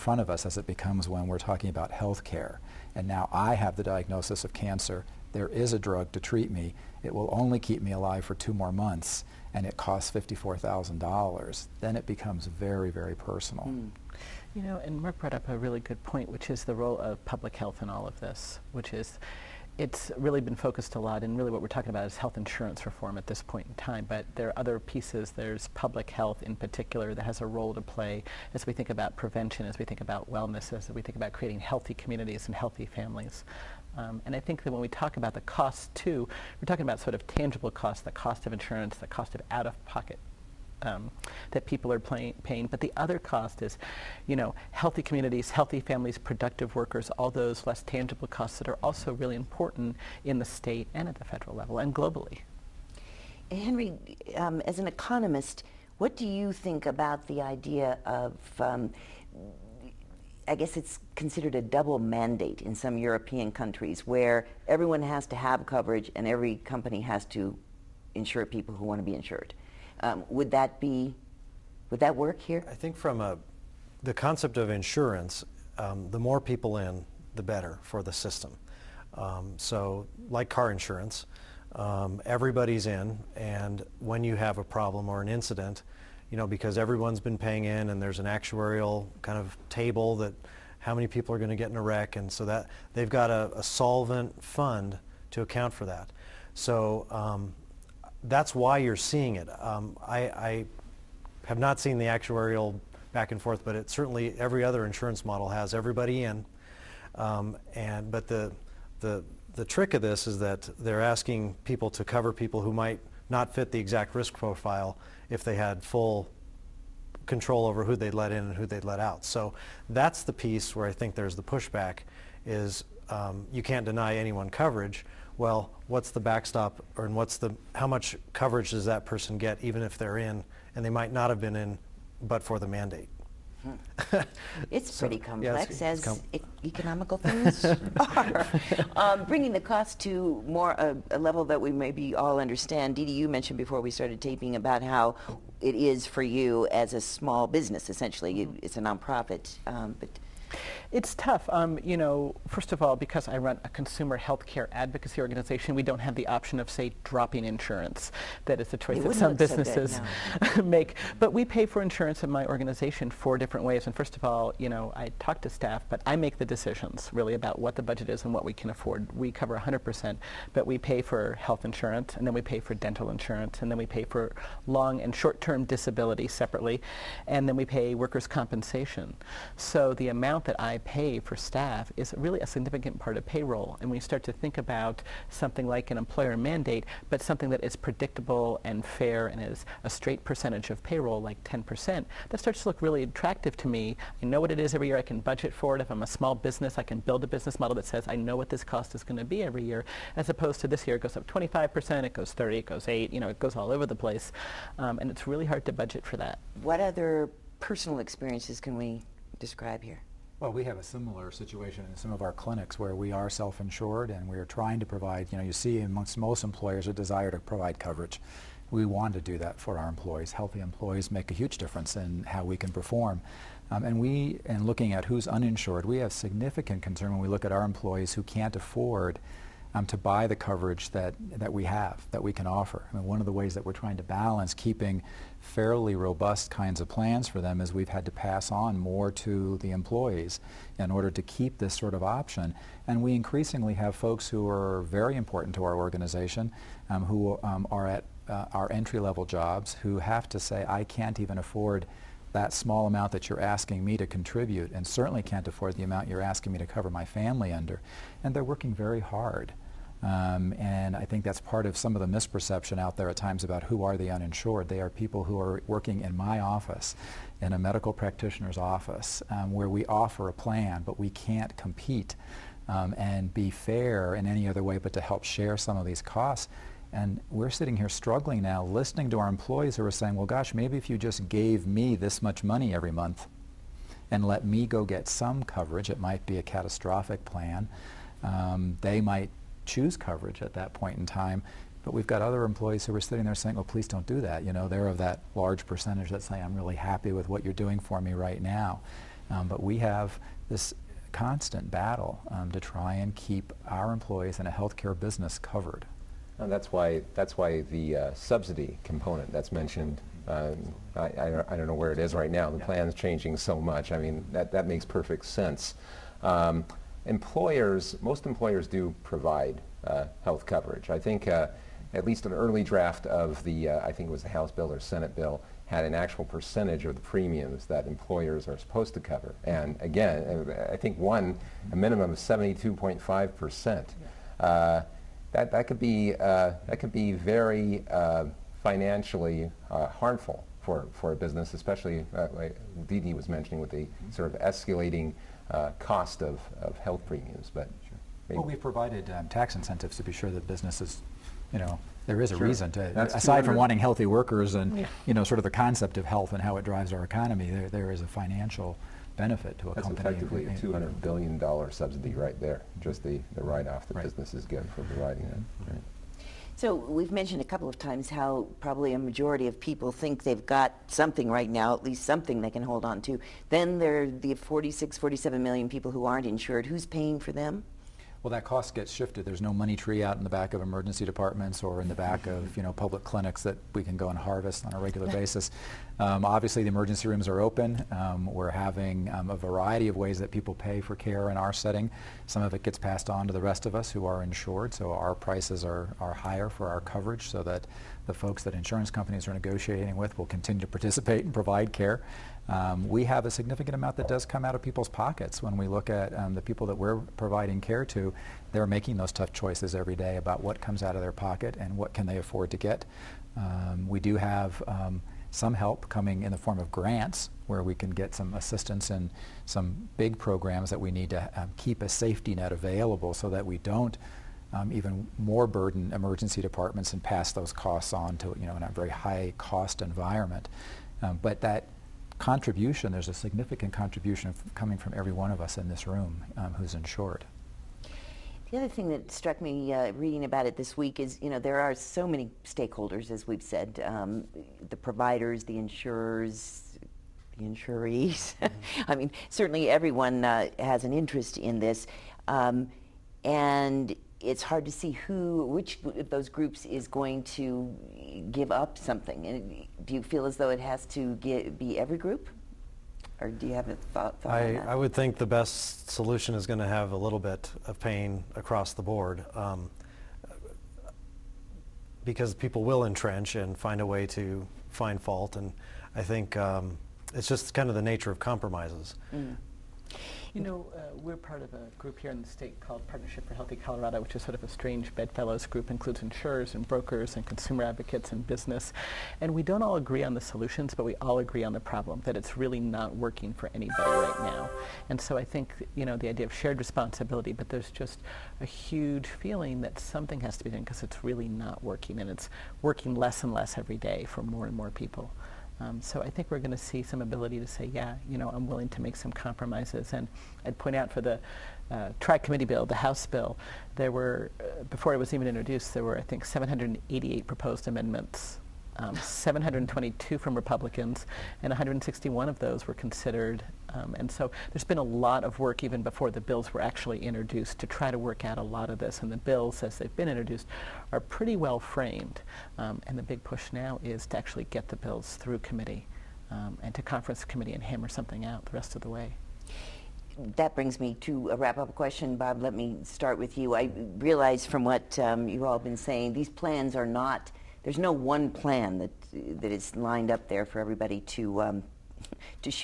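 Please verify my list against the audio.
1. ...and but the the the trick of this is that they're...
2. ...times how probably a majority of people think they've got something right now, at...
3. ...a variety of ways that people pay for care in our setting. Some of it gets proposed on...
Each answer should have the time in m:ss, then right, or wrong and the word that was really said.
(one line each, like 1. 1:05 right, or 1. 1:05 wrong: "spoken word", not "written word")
1. 1:47 right
2. 6:07 right
3. 6:29 wrong: "passed", not "proposed".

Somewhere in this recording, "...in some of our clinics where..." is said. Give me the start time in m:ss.
3:31.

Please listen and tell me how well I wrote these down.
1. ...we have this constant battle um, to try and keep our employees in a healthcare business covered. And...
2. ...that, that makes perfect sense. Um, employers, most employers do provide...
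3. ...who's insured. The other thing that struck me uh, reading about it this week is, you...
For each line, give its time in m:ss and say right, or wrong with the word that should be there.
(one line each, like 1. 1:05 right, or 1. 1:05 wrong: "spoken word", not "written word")
1. 4:59 right
2. 5:14 right
3. 7:16 right.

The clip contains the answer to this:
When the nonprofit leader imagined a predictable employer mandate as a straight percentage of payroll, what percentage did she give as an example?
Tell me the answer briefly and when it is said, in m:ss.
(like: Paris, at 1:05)
10%, at 3:11.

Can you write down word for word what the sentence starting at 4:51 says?
But we've got other employees who are sitting there saying, well, please don't do that.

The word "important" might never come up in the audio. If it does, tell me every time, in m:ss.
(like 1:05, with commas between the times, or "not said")
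0:49, 4:05.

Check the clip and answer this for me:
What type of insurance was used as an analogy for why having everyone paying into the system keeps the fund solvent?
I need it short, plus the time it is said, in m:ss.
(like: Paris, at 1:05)
Car insurance, at 1:20.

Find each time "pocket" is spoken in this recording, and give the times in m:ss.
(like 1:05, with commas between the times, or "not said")
0:39, 6:44, 6:51.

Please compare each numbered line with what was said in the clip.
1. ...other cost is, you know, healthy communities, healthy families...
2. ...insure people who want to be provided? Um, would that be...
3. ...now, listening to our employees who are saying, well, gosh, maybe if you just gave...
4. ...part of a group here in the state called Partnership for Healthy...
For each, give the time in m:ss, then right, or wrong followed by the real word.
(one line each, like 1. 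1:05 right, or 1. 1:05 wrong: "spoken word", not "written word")
1. 0:42 right
2. 1:08 wrong: "insured", not "provided"
3. 4:38 right
4. 8:01 right.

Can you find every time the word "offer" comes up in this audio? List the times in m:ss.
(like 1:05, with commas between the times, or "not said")
3:52, 4:29.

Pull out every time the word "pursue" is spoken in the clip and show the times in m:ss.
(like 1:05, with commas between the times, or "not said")
not said.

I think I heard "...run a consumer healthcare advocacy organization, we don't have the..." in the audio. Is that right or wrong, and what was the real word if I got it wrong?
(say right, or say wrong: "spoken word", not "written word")
right.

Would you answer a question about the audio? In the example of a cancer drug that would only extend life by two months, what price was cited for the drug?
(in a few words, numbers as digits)
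$54,000.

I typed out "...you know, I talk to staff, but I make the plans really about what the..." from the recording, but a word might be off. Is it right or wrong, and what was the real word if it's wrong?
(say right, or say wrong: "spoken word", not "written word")
wrong: "decisions", not "plans".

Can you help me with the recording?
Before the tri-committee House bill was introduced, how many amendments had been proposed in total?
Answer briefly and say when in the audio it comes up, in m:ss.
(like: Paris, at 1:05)
788, at 8:36.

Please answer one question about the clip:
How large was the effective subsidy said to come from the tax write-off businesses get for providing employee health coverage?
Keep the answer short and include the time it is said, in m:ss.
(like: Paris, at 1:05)
200 billion dollars, at 6:00.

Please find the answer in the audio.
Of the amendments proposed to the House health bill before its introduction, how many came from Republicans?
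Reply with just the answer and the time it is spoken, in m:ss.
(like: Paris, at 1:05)
722, at 8:38.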